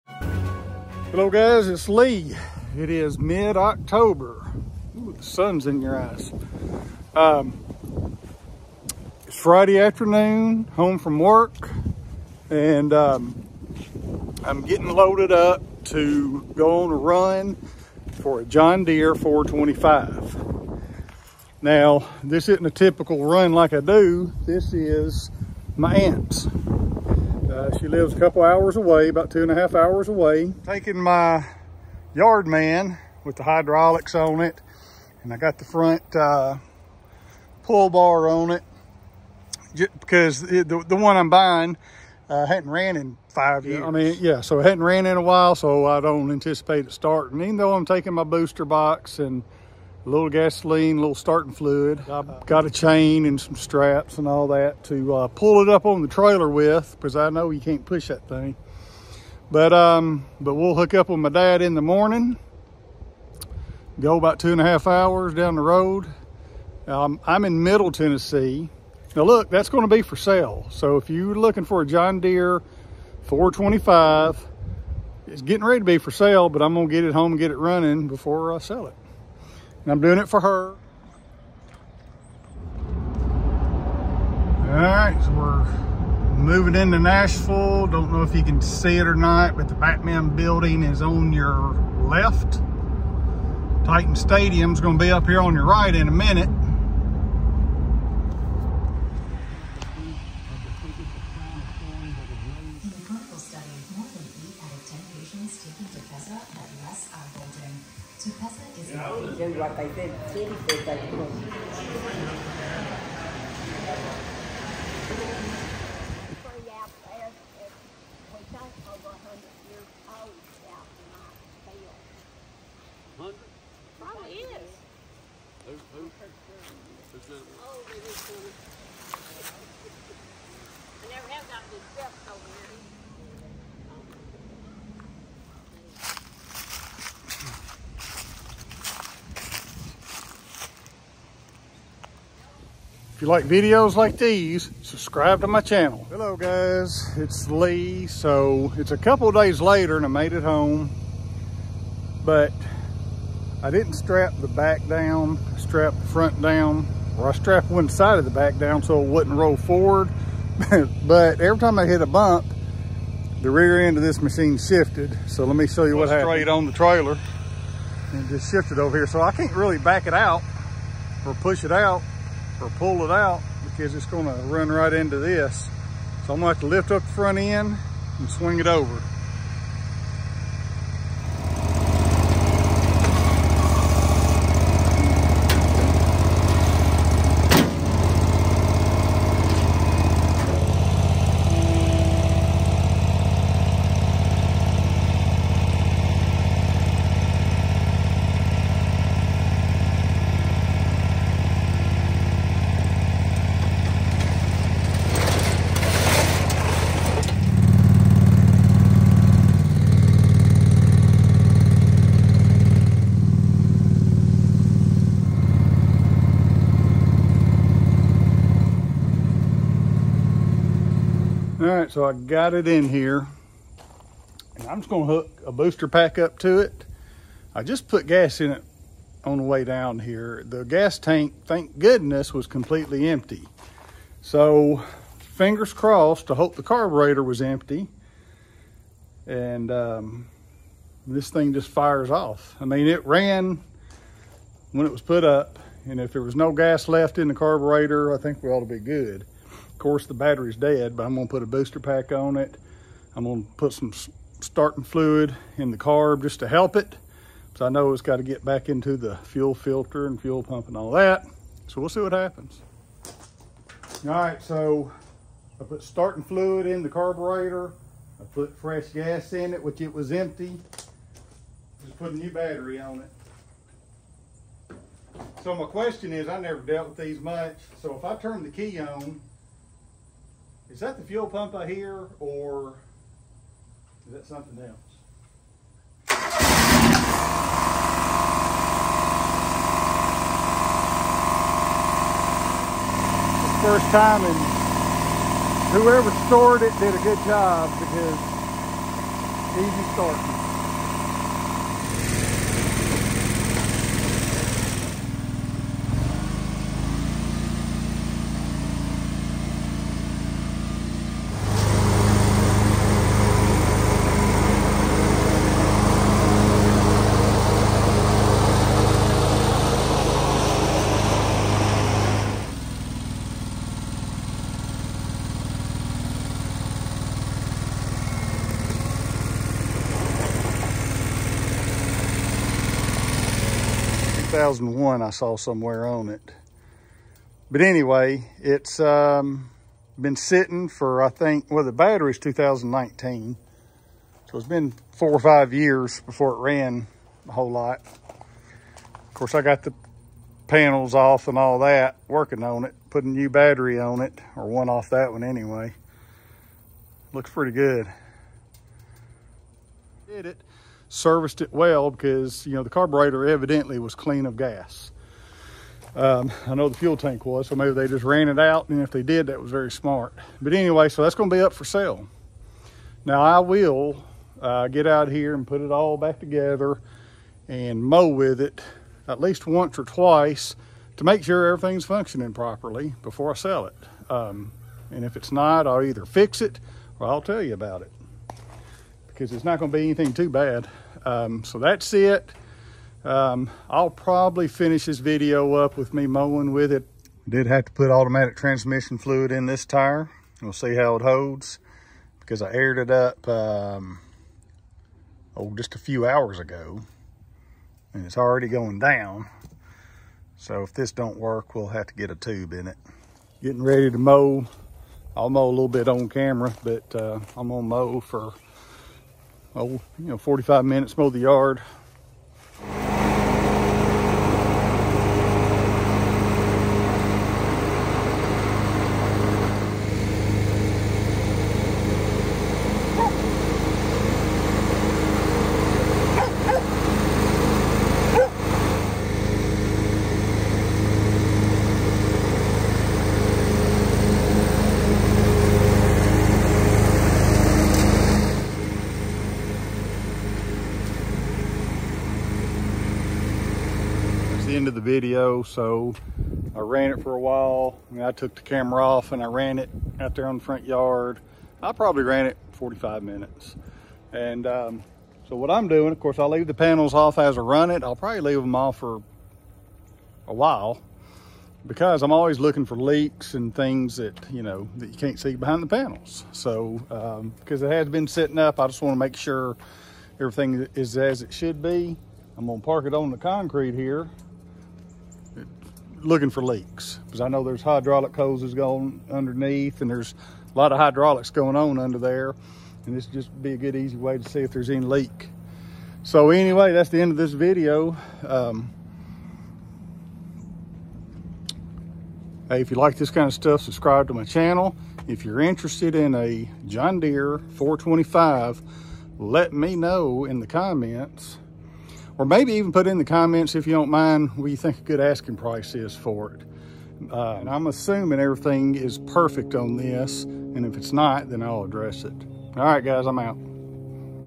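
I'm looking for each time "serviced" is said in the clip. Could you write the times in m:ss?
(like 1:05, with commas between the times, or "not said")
6:00.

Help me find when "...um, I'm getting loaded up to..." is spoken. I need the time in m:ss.
0:12.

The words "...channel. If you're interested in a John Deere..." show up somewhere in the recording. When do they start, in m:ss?
8:24.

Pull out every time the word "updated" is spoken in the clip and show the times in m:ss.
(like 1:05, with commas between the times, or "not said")
not said.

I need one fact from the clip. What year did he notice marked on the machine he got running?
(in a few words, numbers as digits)
2001.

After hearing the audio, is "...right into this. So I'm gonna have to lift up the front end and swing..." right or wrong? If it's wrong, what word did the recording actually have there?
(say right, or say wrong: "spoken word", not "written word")
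right.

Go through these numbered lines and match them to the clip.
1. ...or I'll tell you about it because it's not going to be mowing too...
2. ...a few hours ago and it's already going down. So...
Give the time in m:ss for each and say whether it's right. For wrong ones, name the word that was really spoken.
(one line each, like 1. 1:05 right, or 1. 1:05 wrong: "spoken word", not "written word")
1. 6:26 wrong: "anything", not "mowing"
2. 6:45 right.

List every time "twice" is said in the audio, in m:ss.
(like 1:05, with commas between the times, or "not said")
6:19.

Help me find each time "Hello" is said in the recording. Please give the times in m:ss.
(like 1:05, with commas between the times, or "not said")
0:01, 2:26.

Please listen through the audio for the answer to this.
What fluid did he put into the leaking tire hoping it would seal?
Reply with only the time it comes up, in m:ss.
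6:37.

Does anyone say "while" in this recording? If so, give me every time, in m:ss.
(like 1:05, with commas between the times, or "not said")
0:45, 7:37, 7:50.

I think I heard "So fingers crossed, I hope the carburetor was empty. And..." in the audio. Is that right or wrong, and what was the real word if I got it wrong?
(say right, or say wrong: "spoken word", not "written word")
right.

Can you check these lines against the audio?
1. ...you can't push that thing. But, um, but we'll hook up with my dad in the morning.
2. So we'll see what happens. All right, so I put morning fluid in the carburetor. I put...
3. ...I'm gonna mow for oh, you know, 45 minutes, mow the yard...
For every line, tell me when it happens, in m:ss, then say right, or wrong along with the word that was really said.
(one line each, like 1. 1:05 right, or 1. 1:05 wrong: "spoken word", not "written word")
1. 0:57 right
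2. 4:21 wrong: "starting", not "morning"
3. 6:57 right.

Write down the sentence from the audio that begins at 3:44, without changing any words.
And I'm just gonna hook a booster pack up to it.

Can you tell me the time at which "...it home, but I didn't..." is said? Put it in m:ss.
2:30.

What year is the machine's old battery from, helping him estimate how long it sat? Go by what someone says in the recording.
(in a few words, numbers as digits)
2019.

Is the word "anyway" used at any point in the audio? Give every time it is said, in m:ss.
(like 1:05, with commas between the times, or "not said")
5:37, 5:55, 6:10, 8:16.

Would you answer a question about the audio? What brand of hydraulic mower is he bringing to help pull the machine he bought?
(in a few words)
Yard Man.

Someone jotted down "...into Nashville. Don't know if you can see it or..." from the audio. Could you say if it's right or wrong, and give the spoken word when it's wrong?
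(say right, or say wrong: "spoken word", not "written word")
right.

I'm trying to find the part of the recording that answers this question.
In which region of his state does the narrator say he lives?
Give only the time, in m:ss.
1:07.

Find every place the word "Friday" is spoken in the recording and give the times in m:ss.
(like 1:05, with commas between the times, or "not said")
0:09.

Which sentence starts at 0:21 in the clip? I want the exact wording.
Now, this isn't a typical run like I do.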